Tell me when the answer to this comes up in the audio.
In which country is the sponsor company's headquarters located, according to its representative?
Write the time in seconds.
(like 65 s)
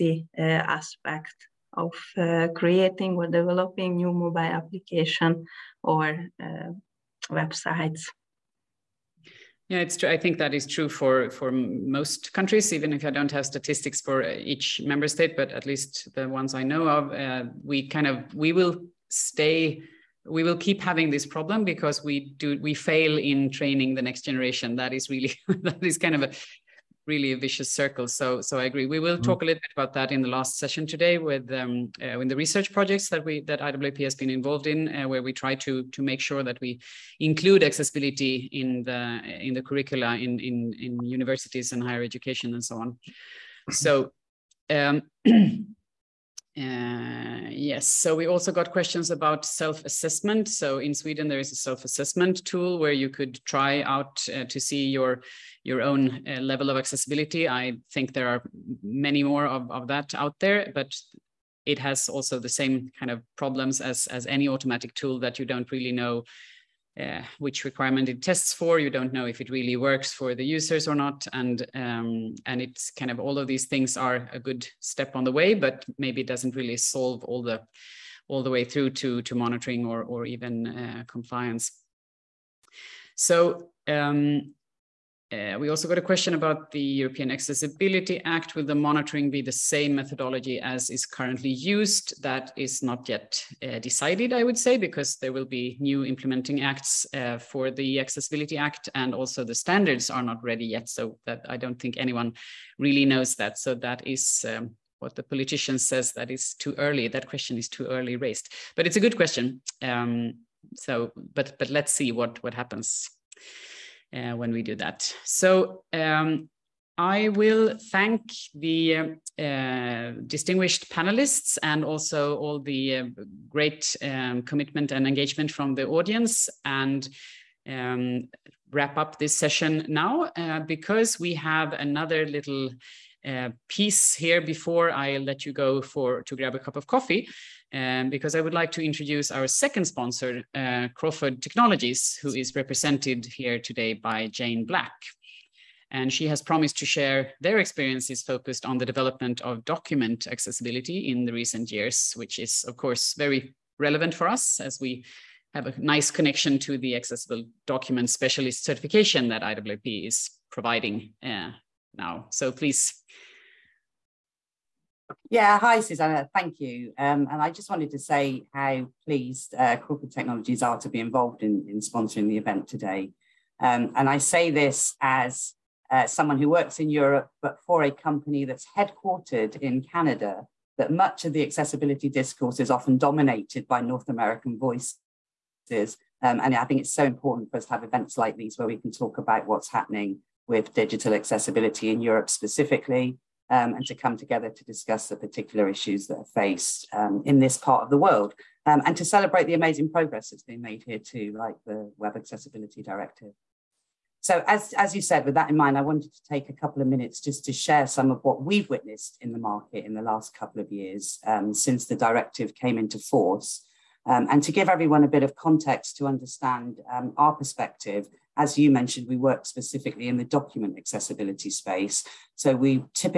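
179 s.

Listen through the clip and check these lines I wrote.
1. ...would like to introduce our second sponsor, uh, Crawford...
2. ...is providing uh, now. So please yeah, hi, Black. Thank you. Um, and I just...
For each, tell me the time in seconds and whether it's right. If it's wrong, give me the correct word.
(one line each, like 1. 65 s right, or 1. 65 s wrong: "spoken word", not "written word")
1. 138 s right
2. 160 s wrong: "Susanna", not "Black".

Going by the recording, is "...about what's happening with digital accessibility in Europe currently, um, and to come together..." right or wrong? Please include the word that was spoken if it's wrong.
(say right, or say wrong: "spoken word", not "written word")
wrong: "specifically", not "currently".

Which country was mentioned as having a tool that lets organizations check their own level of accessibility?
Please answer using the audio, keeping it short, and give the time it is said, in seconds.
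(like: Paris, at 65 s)
Sweden, at 50 s.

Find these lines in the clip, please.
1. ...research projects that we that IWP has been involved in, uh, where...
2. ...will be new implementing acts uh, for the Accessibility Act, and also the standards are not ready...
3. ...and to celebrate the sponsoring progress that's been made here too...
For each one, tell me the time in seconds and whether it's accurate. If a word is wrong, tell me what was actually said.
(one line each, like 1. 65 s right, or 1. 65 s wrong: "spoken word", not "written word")
1. 32 s right
2. 95 s right
3. 198 s wrong: "amazing", not "sponsoring".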